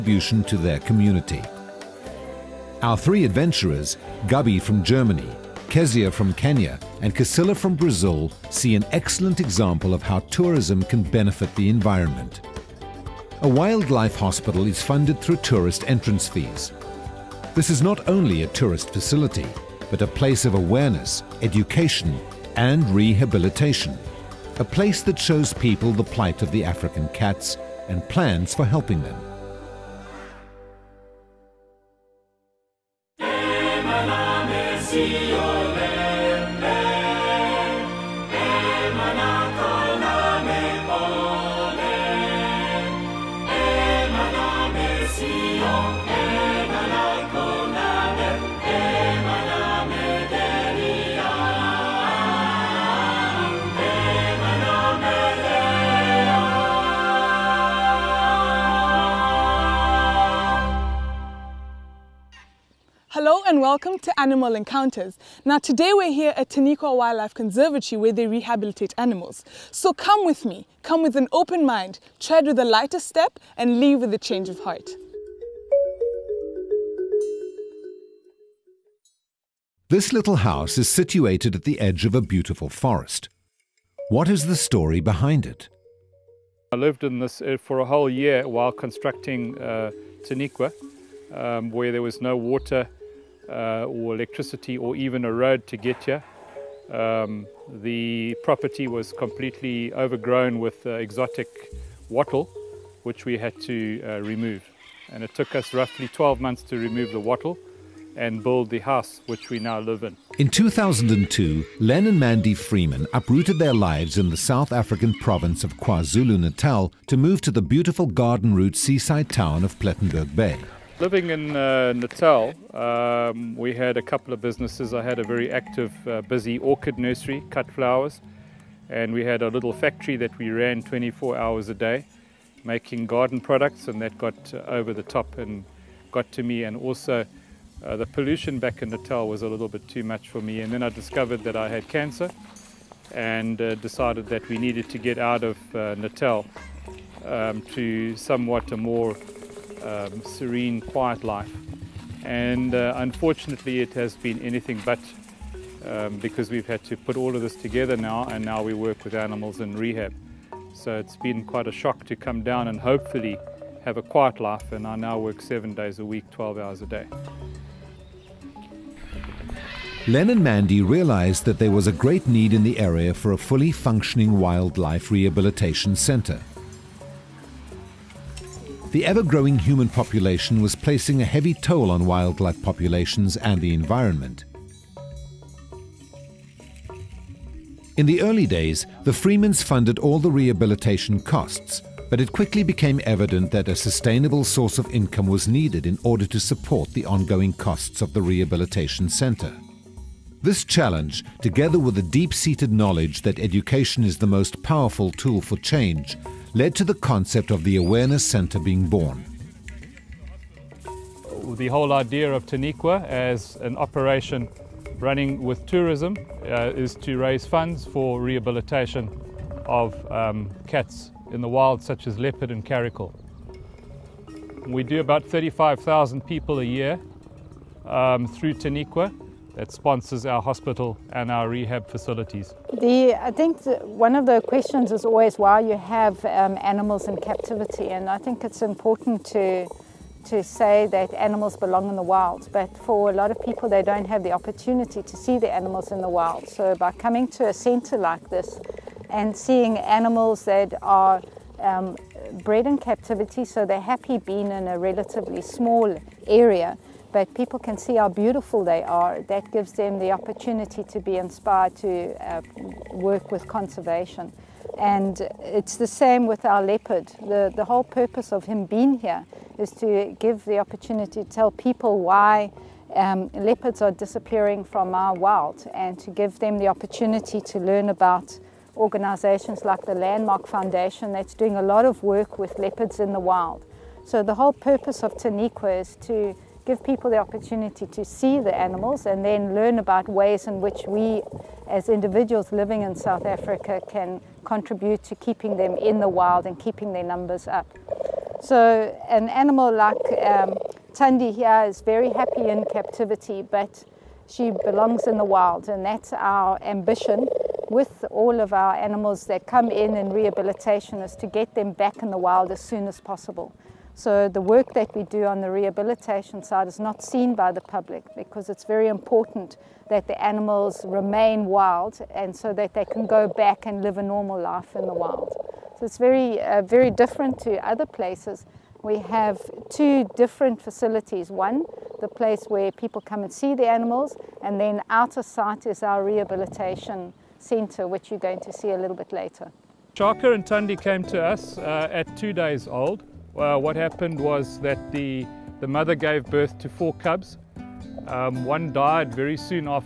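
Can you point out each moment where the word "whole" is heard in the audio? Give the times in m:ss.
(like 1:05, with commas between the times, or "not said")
1:27, 3:31, 4:27, 4:44.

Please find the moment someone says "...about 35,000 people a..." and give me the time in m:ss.
3:44.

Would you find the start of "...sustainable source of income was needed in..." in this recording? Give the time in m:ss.
3:13.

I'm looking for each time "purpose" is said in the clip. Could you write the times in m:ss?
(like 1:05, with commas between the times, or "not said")
4:27, 4:44.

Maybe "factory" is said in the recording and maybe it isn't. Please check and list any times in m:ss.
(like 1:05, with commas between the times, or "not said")
2:09.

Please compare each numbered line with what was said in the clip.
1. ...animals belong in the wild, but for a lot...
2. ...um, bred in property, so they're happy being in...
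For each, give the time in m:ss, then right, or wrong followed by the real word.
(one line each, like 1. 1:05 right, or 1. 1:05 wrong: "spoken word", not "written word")
1. 4:01 right
2. 4:11 wrong: "captivity", not "property".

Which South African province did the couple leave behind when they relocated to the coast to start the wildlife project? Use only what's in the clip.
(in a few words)
KwaZulu Natal.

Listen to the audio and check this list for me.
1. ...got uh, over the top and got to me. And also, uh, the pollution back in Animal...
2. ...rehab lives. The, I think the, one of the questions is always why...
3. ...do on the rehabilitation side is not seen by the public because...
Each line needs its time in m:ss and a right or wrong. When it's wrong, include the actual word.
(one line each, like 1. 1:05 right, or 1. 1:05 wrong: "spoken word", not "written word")
1. 2:14 wrong: "Natal", not "Animal"
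2. 3:51 wrong: "facilities", not "lives"
3. 5:15 right.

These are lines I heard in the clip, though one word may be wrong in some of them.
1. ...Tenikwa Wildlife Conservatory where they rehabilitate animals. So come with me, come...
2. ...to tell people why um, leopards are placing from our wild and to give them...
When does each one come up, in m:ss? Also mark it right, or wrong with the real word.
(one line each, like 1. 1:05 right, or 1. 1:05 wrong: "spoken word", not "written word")
1. 1:06 right
2. 4:31 wrong: "disappearing", not "placing".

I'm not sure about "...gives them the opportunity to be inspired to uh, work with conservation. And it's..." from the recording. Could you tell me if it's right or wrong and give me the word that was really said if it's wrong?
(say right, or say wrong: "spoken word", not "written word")
right.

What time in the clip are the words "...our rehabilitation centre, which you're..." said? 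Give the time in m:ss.
5:35.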